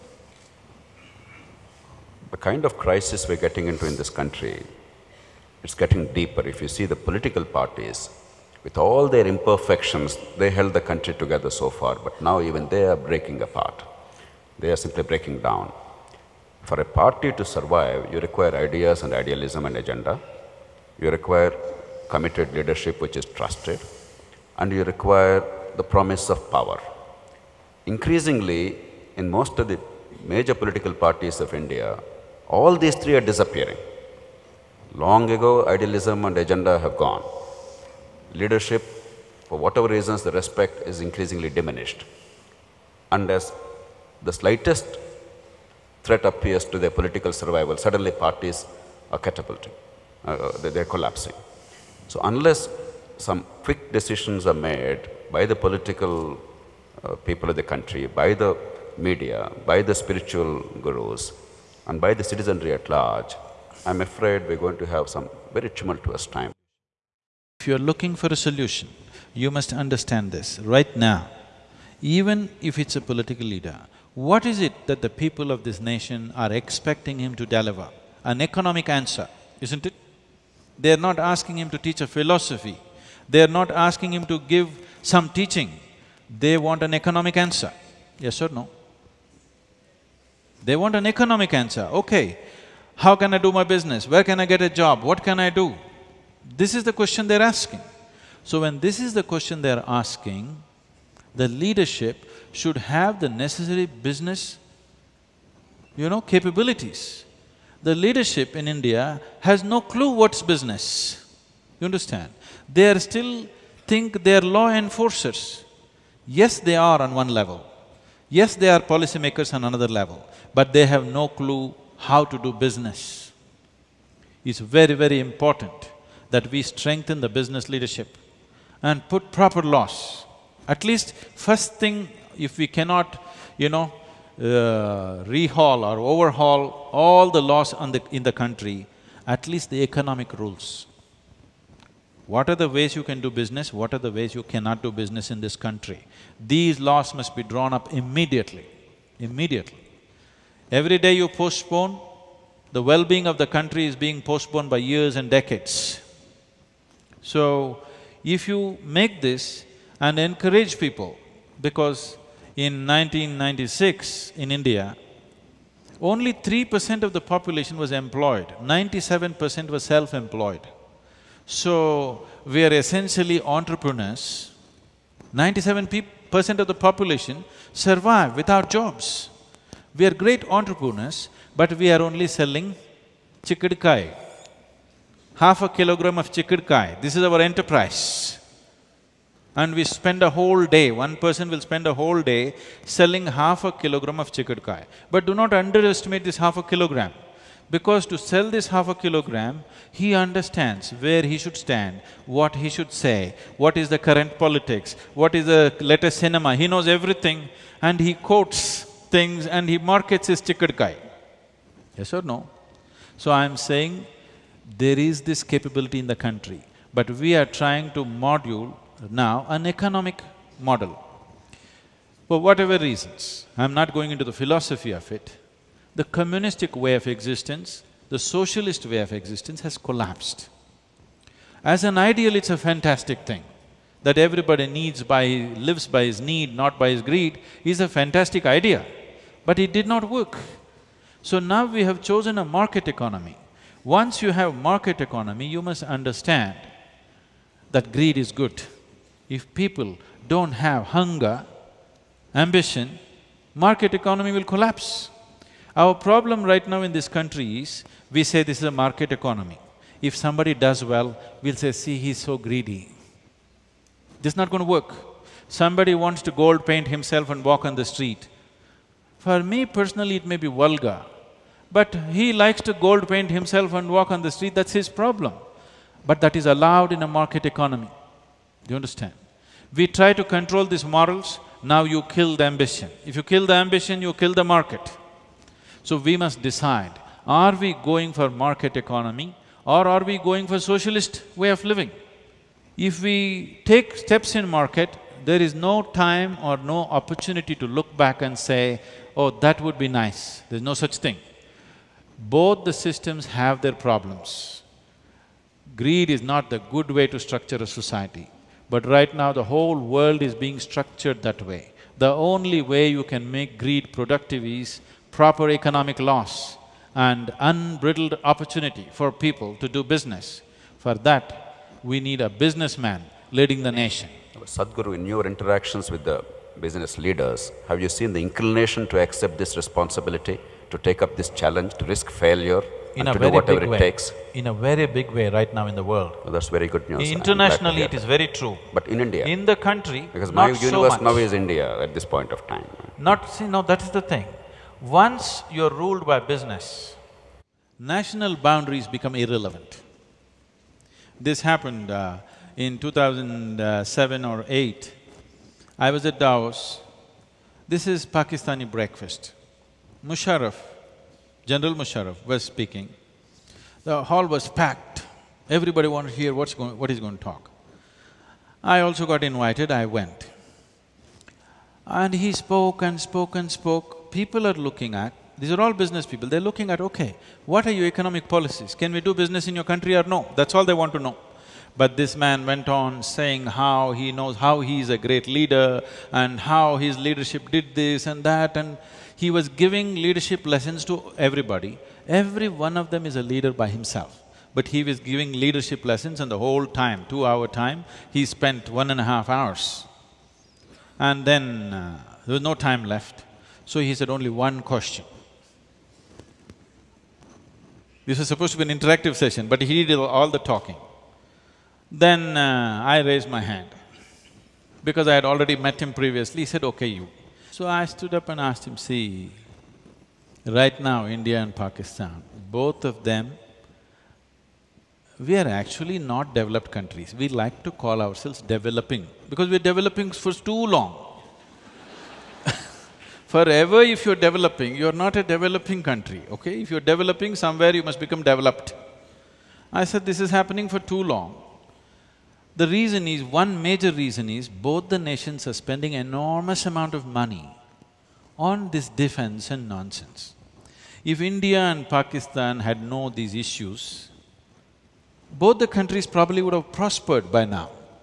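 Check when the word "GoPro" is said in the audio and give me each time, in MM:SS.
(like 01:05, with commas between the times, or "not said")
not said.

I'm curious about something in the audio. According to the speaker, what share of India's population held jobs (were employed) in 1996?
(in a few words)
3 percent.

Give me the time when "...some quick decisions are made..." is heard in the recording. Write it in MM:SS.
00:53.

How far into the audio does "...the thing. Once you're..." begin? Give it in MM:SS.
05:43.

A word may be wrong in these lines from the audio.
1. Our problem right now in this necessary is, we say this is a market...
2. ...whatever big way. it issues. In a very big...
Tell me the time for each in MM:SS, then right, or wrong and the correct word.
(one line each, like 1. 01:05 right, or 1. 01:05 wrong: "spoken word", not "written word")
1. 04:15 wrong: "country", not "necessary"
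2. 05:33 wrong: "takes", not "issues".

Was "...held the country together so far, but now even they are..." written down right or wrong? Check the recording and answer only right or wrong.
right.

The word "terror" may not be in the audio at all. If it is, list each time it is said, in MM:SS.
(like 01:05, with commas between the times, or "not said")
not said.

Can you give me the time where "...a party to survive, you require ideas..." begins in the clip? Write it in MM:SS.
00:16.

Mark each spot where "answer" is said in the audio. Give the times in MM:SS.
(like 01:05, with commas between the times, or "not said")
01:18, 01:27, 01:31.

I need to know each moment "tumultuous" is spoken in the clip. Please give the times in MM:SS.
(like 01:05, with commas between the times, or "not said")
01:05.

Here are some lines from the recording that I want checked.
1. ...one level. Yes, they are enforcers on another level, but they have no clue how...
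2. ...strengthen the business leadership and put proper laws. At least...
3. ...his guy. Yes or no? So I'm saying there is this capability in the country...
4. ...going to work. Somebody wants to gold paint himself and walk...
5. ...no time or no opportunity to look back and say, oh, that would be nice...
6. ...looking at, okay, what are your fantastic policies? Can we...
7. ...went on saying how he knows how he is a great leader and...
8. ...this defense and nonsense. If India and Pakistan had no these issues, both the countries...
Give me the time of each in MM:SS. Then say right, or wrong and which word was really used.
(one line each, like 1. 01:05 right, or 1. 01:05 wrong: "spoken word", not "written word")
1. 01:57 wrong: "policymakers", not "enforcers"
2. 02:06 right
3. 03:30 right
4. 04:24 right
5. 04:55 right
6. 06:16 wrong: "economic", not "fantastic"
7. 06:22 right
8. 07:28 right.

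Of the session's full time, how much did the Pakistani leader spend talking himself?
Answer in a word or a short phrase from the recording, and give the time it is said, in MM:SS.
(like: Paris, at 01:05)
one and a half hours, at 06:38.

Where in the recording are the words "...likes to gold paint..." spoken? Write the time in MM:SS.
04:32.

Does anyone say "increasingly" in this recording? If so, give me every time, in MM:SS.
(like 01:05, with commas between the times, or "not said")
00:27, 00:41.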